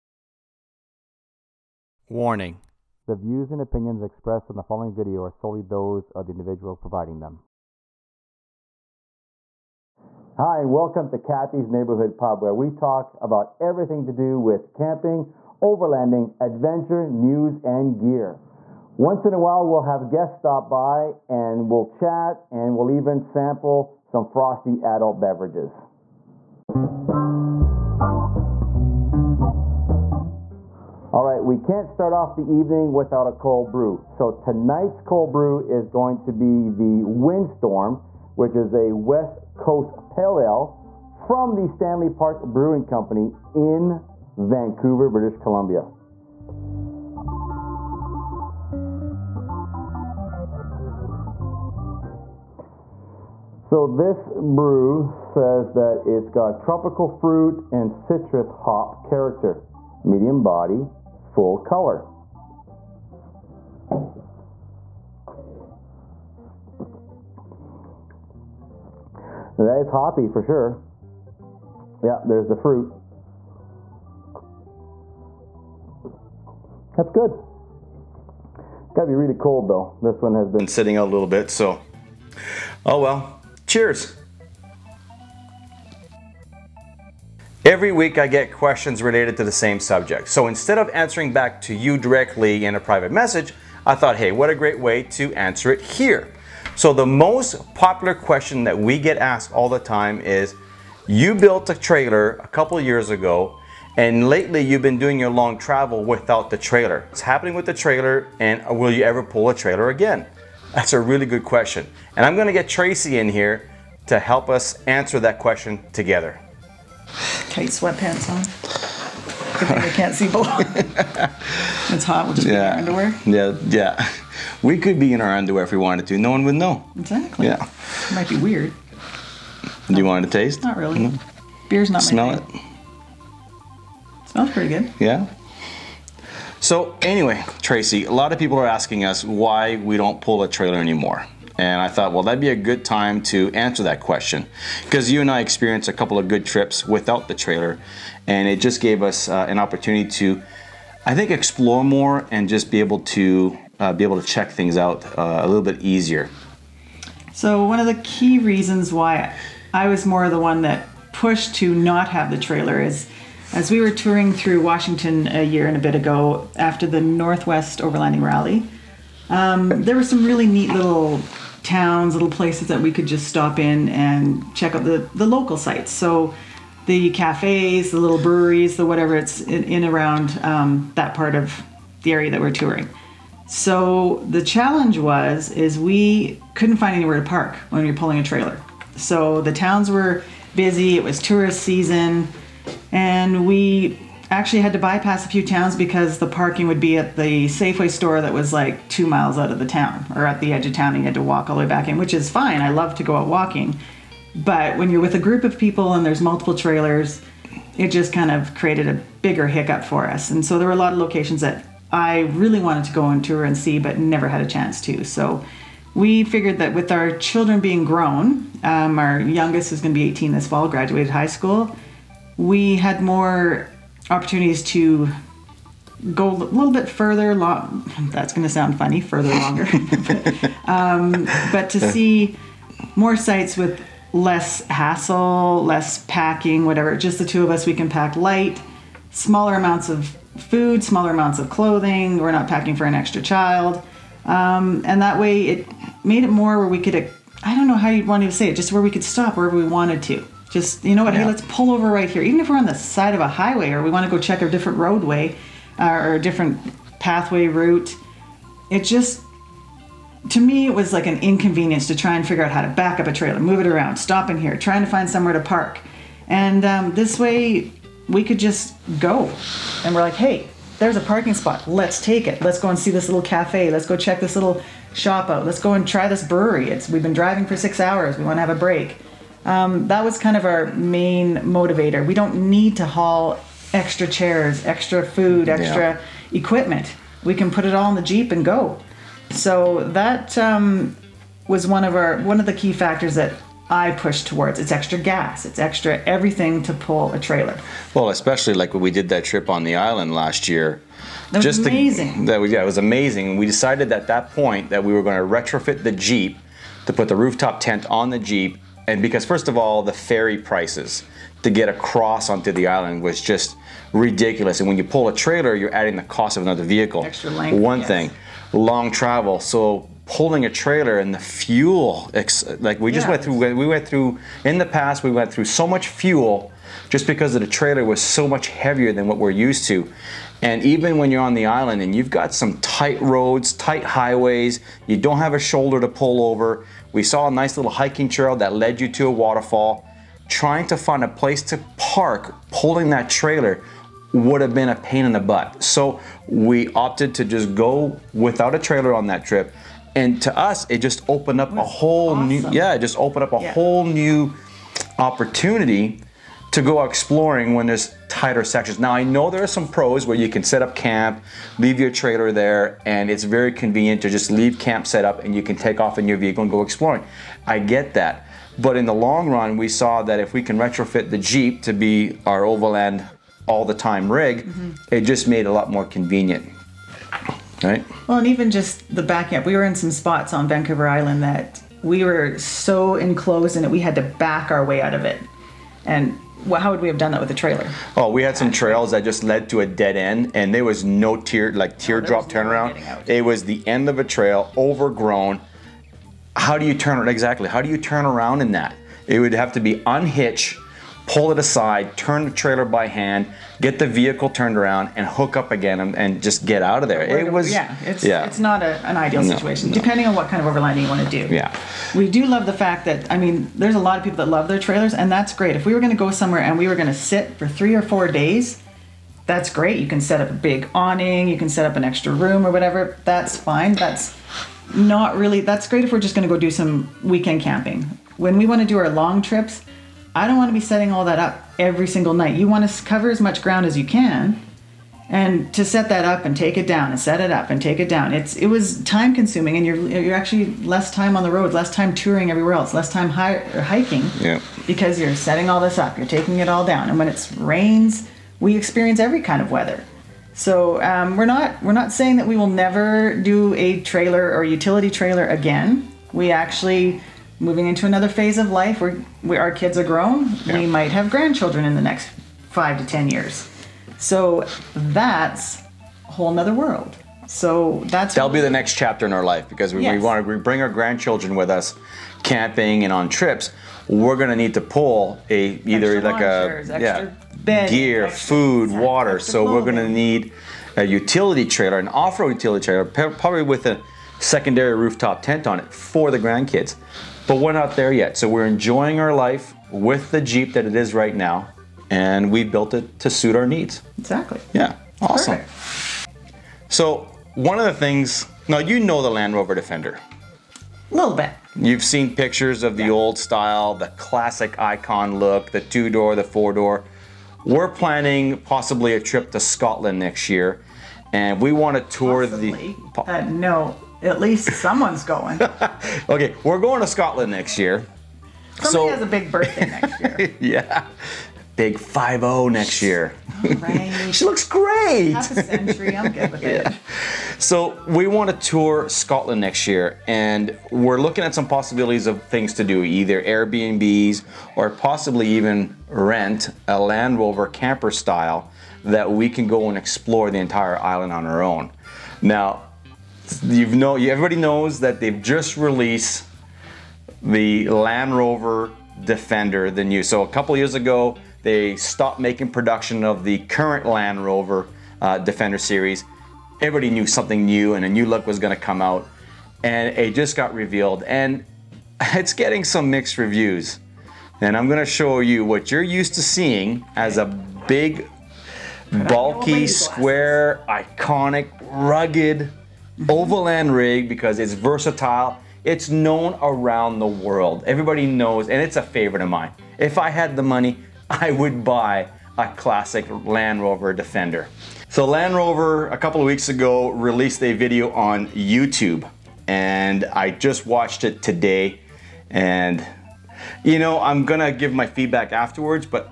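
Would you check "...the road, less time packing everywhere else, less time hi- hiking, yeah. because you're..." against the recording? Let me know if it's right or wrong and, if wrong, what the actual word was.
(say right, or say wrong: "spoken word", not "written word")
wrong: "touring", not "packing".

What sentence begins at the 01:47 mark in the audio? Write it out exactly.
What's happening with the trailer and will you ever pull a trailer again?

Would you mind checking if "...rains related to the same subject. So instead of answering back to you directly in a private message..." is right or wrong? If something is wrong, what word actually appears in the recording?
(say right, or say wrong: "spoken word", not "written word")
wrong: "questions", not "rains".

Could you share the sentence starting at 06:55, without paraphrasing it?
If we were going to go somewhere and we were going to sit for three or four days.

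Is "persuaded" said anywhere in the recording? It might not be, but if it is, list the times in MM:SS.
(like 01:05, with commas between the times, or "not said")
not said.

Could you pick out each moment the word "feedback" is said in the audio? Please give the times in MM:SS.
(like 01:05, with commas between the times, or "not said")
09:54.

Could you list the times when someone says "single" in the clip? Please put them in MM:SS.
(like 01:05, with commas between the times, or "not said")
07:11.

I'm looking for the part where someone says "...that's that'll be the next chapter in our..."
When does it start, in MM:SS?
07:47.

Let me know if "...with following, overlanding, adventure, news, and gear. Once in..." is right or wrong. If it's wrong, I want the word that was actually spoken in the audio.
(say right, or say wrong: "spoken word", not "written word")
wrong: "camping", not "following".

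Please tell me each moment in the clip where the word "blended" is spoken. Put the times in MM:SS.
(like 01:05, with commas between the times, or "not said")
not said.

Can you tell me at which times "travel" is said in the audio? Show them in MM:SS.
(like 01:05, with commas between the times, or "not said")
01:45, 05:18.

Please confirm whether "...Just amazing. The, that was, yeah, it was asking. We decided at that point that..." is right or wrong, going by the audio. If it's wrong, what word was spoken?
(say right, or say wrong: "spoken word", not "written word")
wrong: "amazing", not "asking".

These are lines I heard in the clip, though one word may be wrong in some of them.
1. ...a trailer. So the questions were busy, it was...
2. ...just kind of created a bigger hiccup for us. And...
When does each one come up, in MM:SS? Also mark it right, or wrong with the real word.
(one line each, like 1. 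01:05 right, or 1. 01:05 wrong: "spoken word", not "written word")
1. 03:08 wrong: "towns", not "questions"
2. 03:27 right.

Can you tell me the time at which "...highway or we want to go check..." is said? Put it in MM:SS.
04:13.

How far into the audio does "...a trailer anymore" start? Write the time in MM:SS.
02:20.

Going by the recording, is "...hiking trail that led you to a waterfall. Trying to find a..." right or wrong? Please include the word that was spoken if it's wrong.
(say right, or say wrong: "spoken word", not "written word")
right.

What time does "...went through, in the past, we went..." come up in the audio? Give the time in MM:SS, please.
05:23.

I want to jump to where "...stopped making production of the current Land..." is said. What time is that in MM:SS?
09:11.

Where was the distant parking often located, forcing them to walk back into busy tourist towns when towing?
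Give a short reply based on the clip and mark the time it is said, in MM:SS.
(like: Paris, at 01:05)
Safeway store, at 03:17.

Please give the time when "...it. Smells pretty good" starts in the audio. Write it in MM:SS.
02:14.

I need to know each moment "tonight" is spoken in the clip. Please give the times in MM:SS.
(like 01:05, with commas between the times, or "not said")
00:34.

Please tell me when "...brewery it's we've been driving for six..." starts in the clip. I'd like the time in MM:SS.
04:36.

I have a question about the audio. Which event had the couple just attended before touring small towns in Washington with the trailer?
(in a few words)
Northwest Overlanding Rally.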